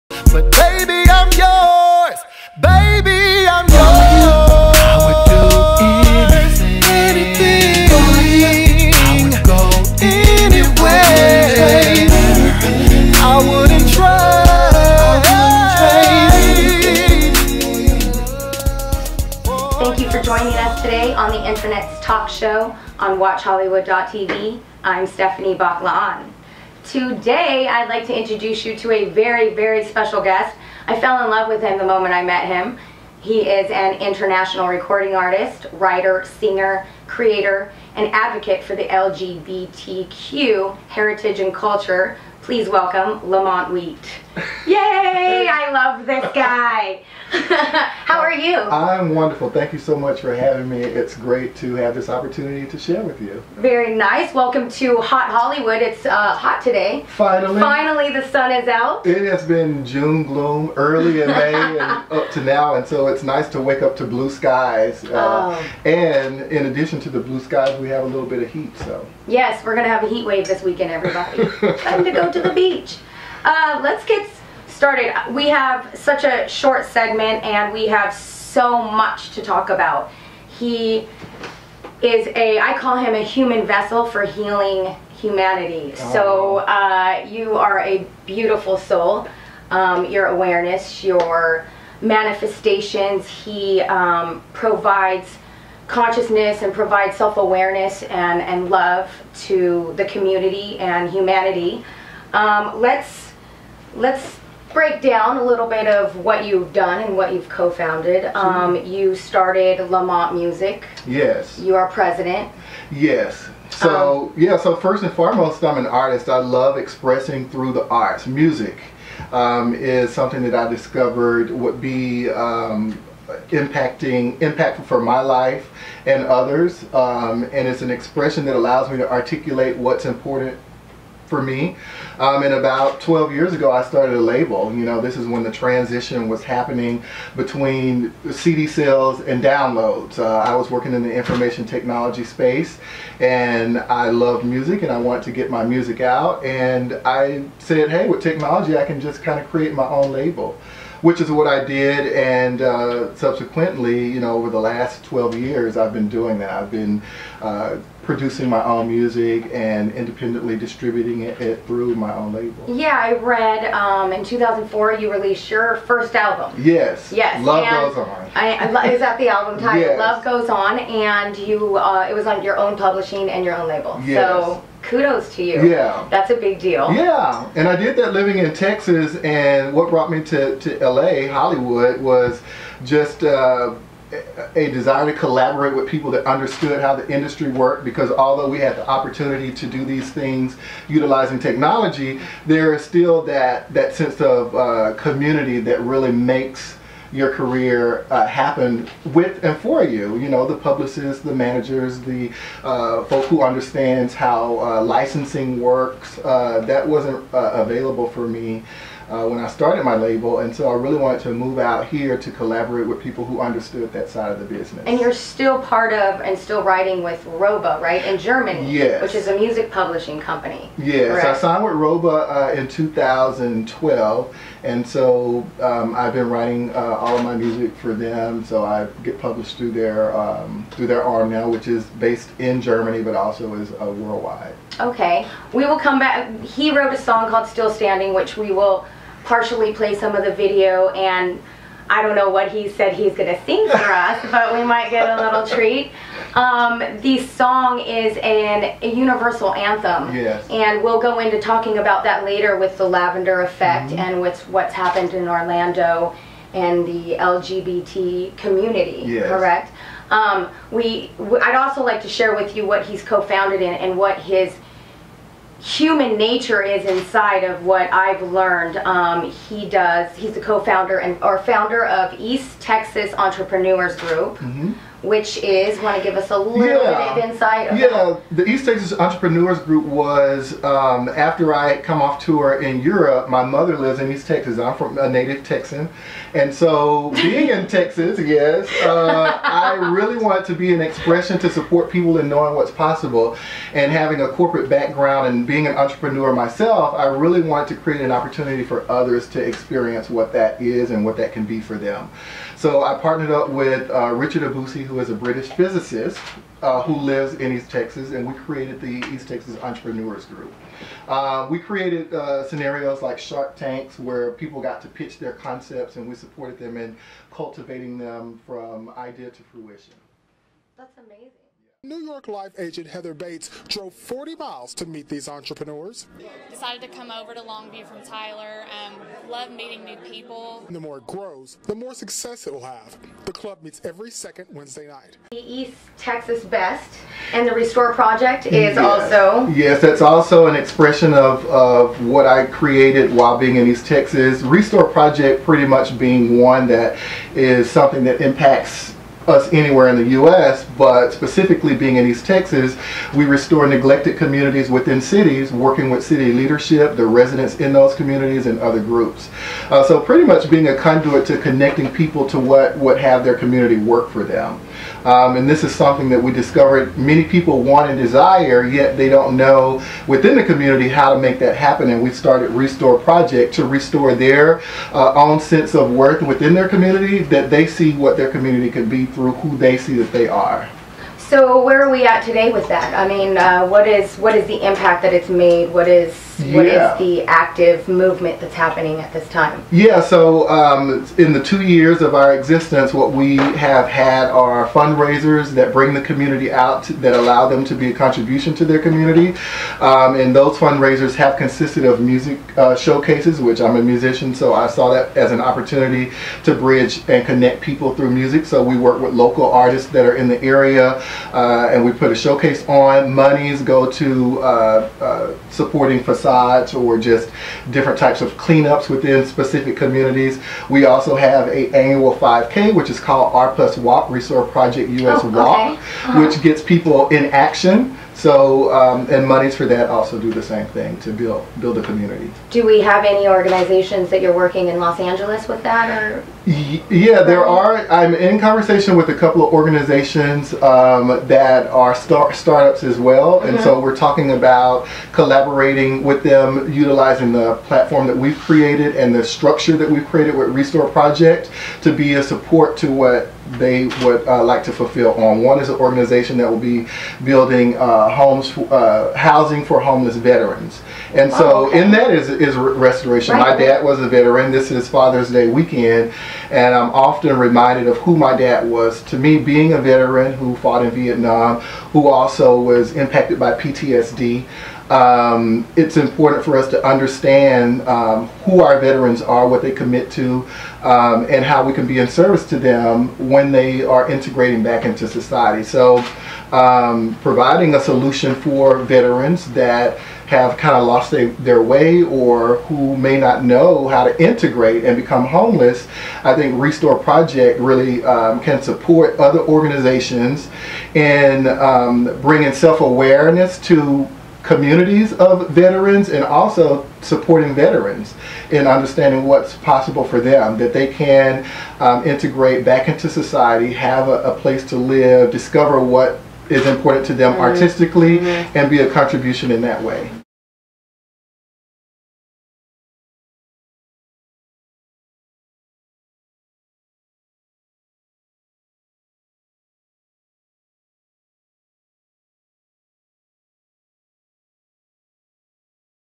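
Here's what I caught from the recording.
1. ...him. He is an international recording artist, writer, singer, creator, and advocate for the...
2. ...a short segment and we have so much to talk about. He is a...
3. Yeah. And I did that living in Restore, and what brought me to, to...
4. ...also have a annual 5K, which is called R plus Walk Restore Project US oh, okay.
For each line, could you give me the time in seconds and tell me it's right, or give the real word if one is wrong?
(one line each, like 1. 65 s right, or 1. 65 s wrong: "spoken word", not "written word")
1. 32 s right
2. 76 s right
3. 176 s wrong: "Texas", not "Restore"
4. 420 s right.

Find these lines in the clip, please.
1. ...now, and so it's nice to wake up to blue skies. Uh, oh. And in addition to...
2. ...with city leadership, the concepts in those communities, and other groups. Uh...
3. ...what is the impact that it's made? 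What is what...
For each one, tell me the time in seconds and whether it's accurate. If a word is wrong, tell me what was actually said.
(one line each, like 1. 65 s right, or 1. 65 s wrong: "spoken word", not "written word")
1. 62 s right
2. 355 s wrong: "residents", not "concepts"
3. 384 s right.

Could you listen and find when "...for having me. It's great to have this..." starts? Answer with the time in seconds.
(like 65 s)
50 s.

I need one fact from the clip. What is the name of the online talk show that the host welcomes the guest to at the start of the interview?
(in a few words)
Hot Hollywood.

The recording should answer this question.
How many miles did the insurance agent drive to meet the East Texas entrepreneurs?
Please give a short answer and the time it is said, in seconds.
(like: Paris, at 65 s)
40, at 323 s.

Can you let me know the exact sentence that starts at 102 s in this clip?
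Um, let's let's break down a little bit of what you've done and what you've co-founded.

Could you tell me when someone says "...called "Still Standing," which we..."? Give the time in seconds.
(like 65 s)
237 s.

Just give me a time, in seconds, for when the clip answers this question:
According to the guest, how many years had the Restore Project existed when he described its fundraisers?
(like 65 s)
391 s.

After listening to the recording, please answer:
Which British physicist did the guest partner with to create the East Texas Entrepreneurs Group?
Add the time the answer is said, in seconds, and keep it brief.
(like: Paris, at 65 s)
Richard Abusi, at 304 s.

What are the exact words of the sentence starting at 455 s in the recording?
One is an organization that will be building uh, homes, uh, housing for homeless veterans.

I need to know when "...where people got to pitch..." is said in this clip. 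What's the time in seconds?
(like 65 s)
313 s.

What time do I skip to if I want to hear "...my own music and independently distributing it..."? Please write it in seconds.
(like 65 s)
158 s.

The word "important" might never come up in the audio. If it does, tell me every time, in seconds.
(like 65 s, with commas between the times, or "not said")
130 s, 475 s, 516 s.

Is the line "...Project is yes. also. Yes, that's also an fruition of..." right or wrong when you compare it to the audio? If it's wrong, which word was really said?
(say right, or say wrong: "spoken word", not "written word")
wrong: "expression", not "fruition".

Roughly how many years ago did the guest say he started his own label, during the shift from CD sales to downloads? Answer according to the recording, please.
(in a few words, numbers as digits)
12.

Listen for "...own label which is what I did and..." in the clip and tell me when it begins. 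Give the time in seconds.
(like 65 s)
149 s.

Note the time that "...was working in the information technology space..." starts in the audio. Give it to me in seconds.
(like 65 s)
140 s.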